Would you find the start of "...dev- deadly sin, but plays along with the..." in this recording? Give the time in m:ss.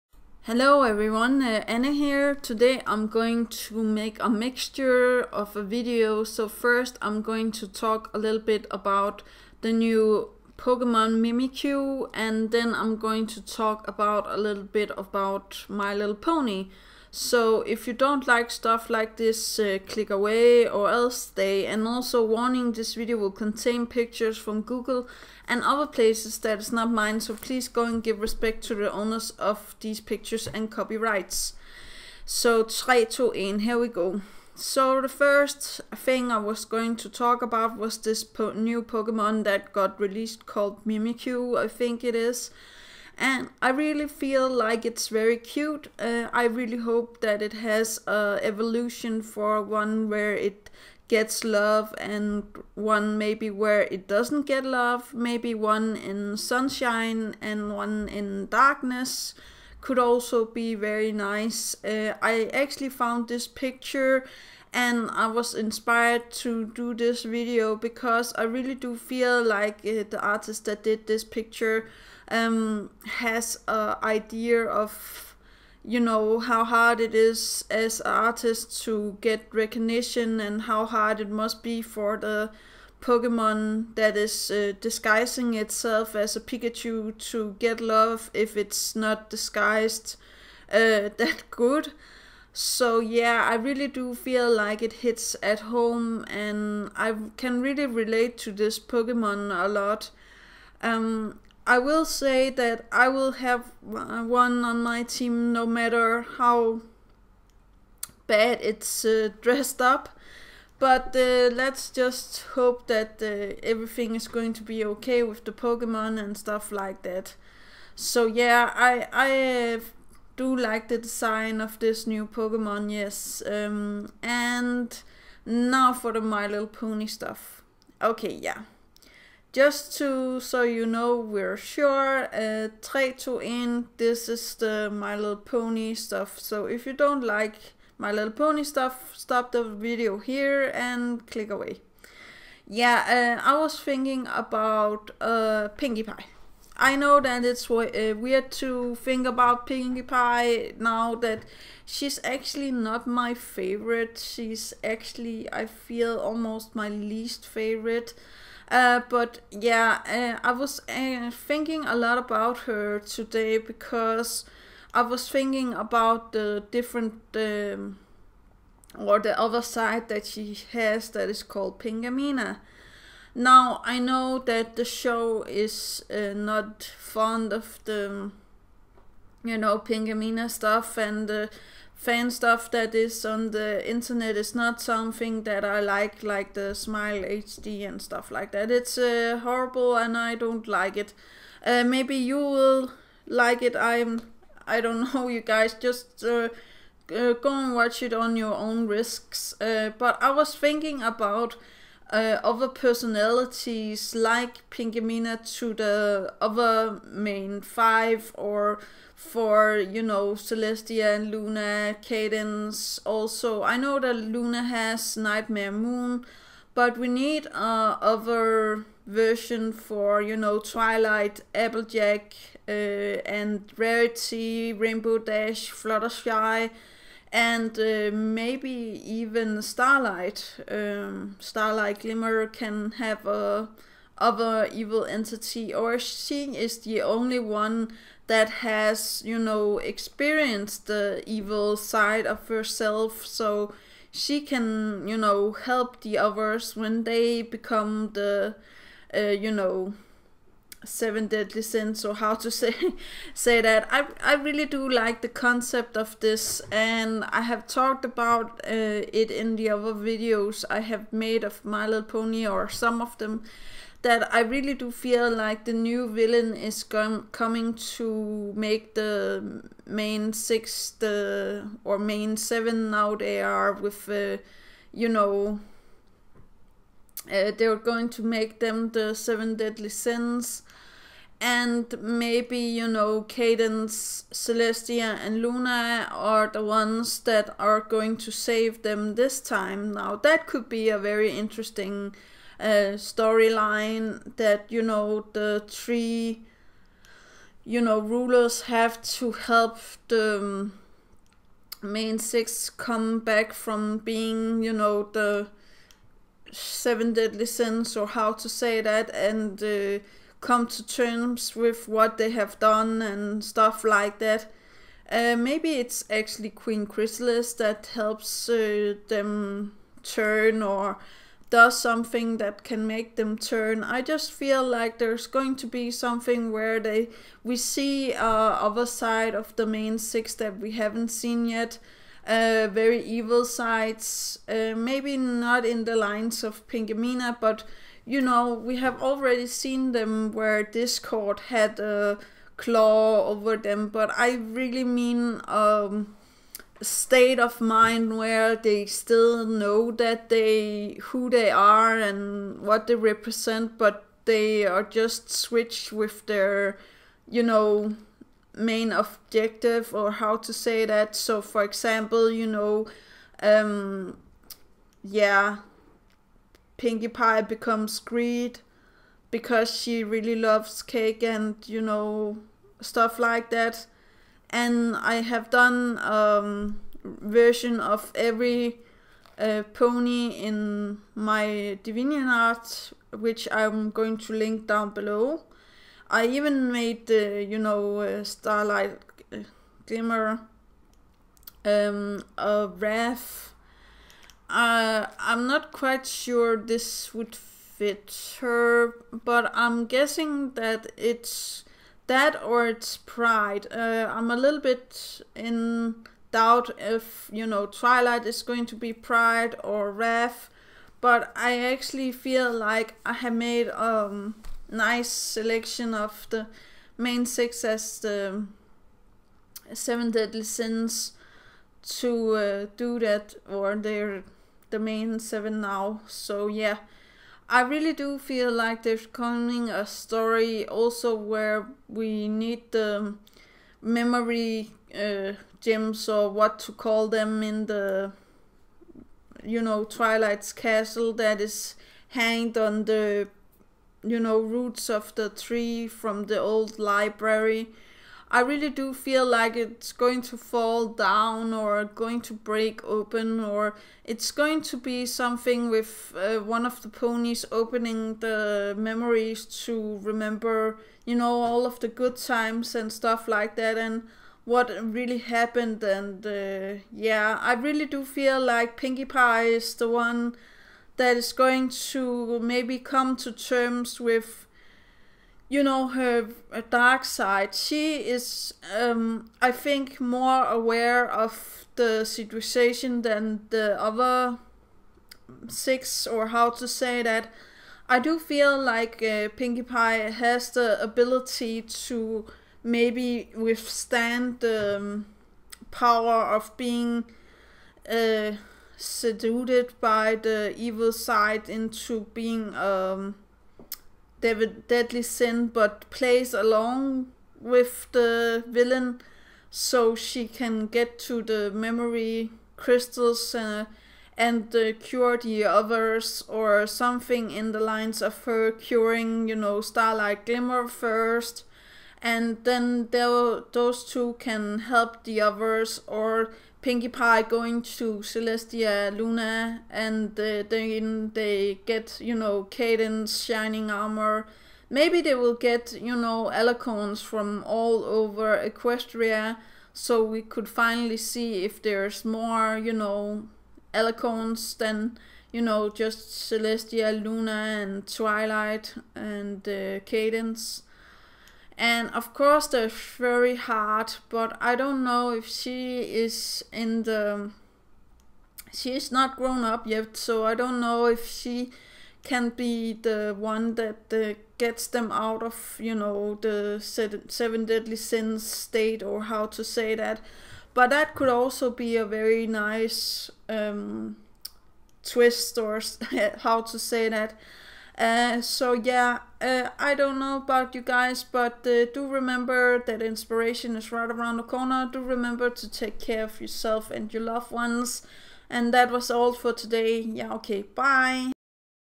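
8:24.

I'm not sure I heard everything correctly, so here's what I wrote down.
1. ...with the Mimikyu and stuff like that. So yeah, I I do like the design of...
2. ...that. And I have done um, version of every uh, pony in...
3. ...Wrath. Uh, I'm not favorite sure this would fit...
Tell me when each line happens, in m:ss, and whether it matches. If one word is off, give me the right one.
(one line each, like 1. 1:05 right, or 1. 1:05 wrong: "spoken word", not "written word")
1. 1:55 wrong: "Pokemon", not "Mimikyu"
2. 6:13 right
3. 6:32 wrong: "quite", not "favorite".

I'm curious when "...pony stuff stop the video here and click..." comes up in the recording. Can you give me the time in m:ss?
2:18.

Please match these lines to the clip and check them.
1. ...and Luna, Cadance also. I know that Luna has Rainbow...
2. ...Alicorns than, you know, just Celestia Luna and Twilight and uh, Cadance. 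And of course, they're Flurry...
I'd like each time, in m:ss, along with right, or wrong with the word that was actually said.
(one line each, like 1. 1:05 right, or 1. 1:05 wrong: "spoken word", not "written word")
1. 3:31 wrong: "Nightmare", not "Rainbow"
2. 9:03 right.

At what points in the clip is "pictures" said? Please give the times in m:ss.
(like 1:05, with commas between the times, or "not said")
0:23, 0:29, 1:03, 1:11.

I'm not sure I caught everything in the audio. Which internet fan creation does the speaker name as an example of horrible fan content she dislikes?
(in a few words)
Smile HD.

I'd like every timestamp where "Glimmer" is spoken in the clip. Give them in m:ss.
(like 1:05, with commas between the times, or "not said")
3:51, 6:29, 8:40.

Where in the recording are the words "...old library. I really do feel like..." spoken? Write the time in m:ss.
7:26.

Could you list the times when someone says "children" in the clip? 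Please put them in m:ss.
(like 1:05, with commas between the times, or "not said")
not said.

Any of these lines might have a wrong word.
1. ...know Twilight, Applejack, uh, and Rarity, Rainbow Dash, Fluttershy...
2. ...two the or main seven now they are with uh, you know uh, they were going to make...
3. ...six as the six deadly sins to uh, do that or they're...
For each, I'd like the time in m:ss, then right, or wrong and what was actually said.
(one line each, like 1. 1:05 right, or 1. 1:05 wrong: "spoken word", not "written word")
1. 3:40 right
2. 4:30 wrong: "six", not "two"
3. 6:57 wrong: "seven", not "six".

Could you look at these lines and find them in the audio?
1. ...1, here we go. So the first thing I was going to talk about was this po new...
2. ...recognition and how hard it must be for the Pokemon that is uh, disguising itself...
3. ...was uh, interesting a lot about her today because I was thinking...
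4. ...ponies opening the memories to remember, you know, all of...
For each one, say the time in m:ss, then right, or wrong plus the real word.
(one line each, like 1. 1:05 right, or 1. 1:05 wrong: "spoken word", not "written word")
1. 0:33 right
2. 1:19 right
3. 2:40 wrong: "thinking", not "interesting"
4. 7:36 right.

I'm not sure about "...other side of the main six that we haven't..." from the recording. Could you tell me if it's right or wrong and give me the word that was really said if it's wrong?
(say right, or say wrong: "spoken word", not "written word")
right.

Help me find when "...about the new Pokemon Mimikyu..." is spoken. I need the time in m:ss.
0:08.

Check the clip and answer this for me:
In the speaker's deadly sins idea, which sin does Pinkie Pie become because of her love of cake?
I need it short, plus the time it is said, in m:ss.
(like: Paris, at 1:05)
Greed, at 6:07.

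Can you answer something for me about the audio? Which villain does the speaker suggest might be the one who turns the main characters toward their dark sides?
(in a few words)
Queen Chrysalis.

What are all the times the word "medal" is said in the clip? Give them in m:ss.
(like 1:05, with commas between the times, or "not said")
not said.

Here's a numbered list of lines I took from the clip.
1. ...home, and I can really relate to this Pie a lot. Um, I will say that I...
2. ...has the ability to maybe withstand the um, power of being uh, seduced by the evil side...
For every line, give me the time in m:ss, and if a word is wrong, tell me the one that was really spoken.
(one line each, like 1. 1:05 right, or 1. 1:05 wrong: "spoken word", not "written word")
1. 1:35 wrong: "Pokemon", not "Pie"
2. 8:10 right.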